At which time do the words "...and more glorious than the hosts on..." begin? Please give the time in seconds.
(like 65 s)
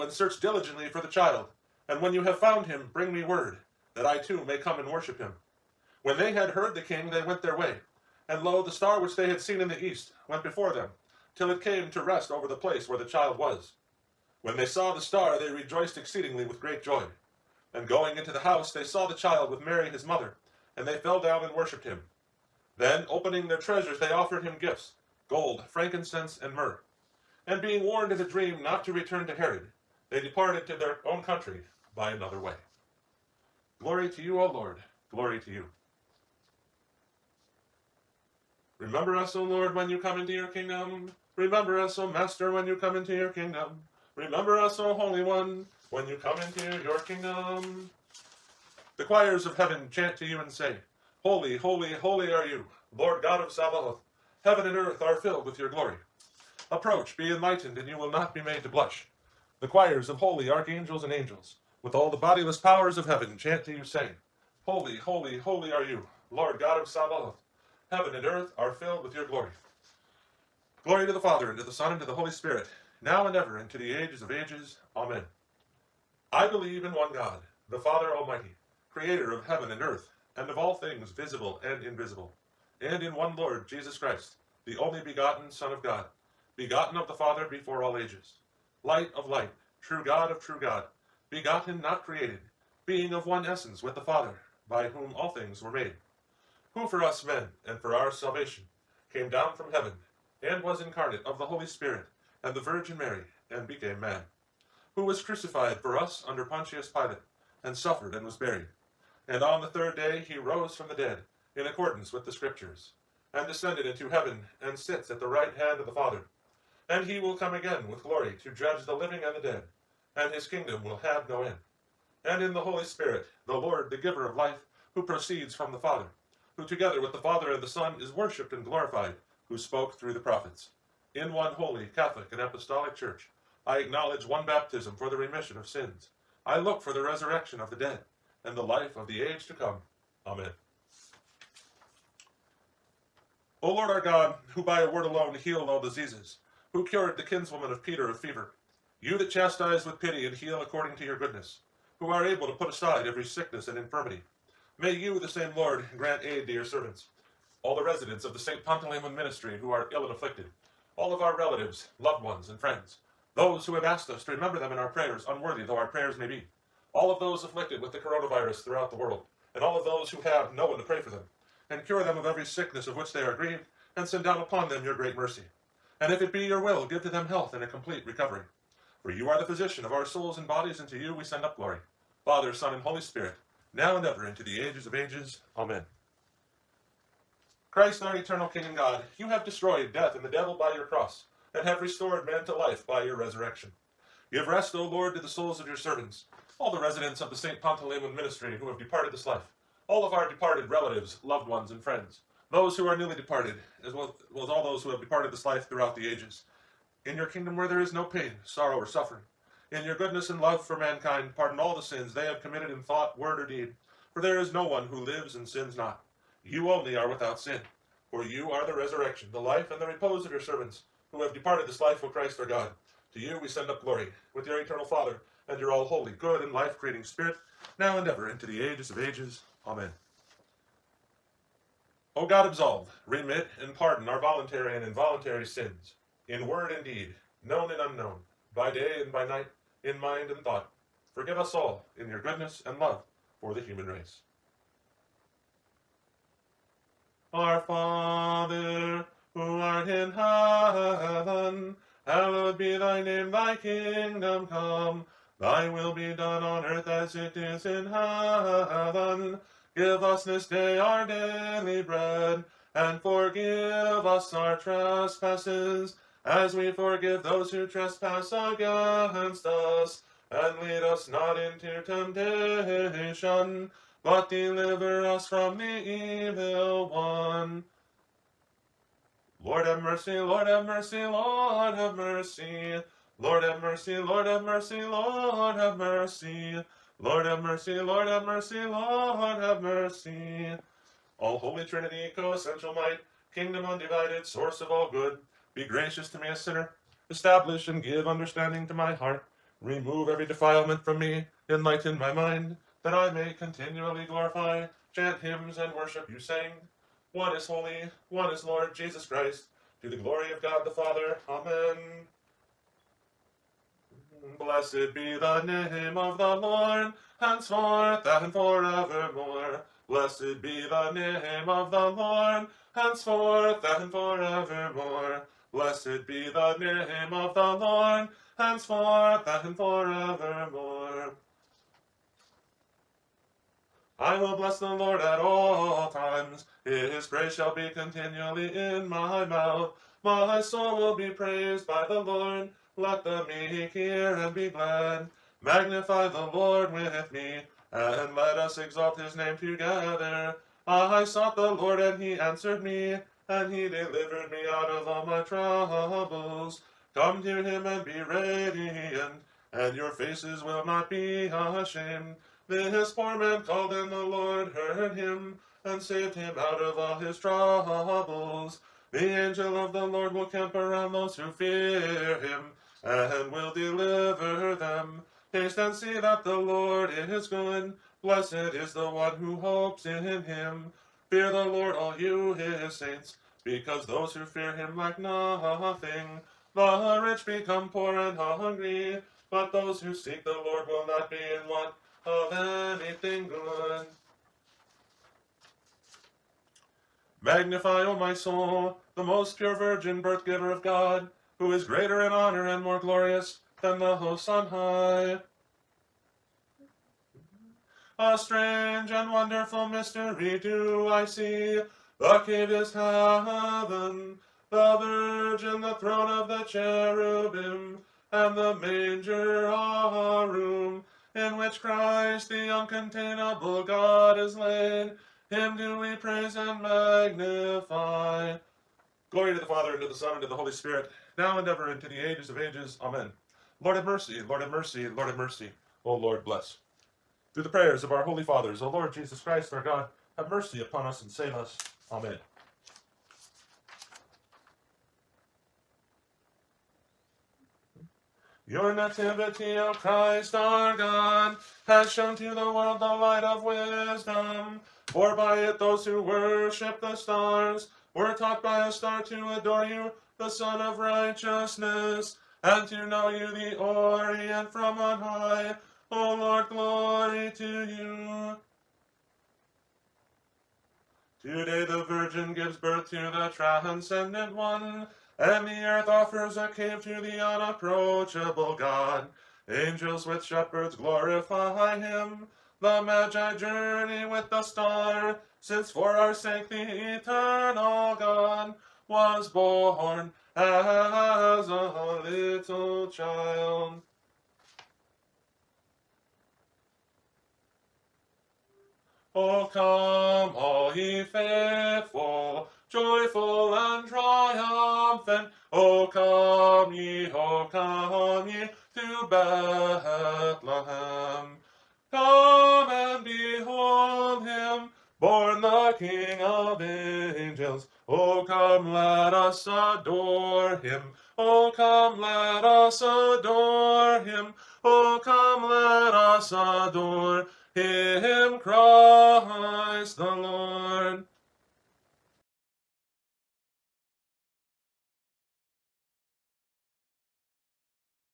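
402 s.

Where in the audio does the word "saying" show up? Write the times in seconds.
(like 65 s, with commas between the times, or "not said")
63 s, 306 s.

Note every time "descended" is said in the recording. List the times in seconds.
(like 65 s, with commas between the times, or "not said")
113 s.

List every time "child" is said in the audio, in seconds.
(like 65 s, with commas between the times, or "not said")
1 s, 13 s, 19 s, 492 s.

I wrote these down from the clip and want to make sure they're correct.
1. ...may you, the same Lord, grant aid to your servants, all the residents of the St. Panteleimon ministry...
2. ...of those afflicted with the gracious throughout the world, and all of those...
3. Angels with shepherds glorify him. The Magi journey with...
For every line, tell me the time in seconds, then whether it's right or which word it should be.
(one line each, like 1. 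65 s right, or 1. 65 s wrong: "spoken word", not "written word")
1. 154 s right
2. 167 s wrong: "coronavirus", not "gracious"
3. 479 s right.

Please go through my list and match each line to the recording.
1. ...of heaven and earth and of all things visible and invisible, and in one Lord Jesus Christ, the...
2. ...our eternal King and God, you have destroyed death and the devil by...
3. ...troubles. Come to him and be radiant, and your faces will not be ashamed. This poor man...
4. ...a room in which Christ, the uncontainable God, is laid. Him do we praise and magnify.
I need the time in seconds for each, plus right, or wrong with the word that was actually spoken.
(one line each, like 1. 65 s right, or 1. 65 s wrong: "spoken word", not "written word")
1. 79 s right
2. 188 s right
3. 355 s right
4. 419 s right.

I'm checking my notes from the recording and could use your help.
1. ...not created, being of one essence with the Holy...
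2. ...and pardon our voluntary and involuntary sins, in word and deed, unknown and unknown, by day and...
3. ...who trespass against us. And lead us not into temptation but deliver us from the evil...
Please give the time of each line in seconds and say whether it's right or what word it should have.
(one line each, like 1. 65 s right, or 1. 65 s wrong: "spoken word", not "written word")
1. 91 s wrong: "Father", not "Holy"
2. 233 s wrong: "known", not "unknown"
3. 267 s right.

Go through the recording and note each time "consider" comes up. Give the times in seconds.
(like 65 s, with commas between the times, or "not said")
not said.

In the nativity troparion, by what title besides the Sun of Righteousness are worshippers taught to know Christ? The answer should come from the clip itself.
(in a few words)
The Orient from on high.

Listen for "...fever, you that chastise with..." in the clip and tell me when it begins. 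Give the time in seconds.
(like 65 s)
148 s.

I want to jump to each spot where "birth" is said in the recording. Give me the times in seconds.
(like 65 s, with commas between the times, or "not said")
400 s, 472 s.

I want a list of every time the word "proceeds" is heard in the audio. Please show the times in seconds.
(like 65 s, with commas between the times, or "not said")
125 s.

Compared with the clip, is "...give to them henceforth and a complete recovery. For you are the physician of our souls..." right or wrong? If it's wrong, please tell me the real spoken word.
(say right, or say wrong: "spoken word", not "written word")
wrong: "health", not "henceforth".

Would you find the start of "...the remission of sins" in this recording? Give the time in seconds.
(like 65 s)
135 s.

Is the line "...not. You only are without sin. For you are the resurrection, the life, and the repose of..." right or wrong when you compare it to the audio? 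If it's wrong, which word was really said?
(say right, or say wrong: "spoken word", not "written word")
right.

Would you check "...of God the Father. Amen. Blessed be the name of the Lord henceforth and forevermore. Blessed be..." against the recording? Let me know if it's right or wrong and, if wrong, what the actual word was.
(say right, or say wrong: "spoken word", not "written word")
right.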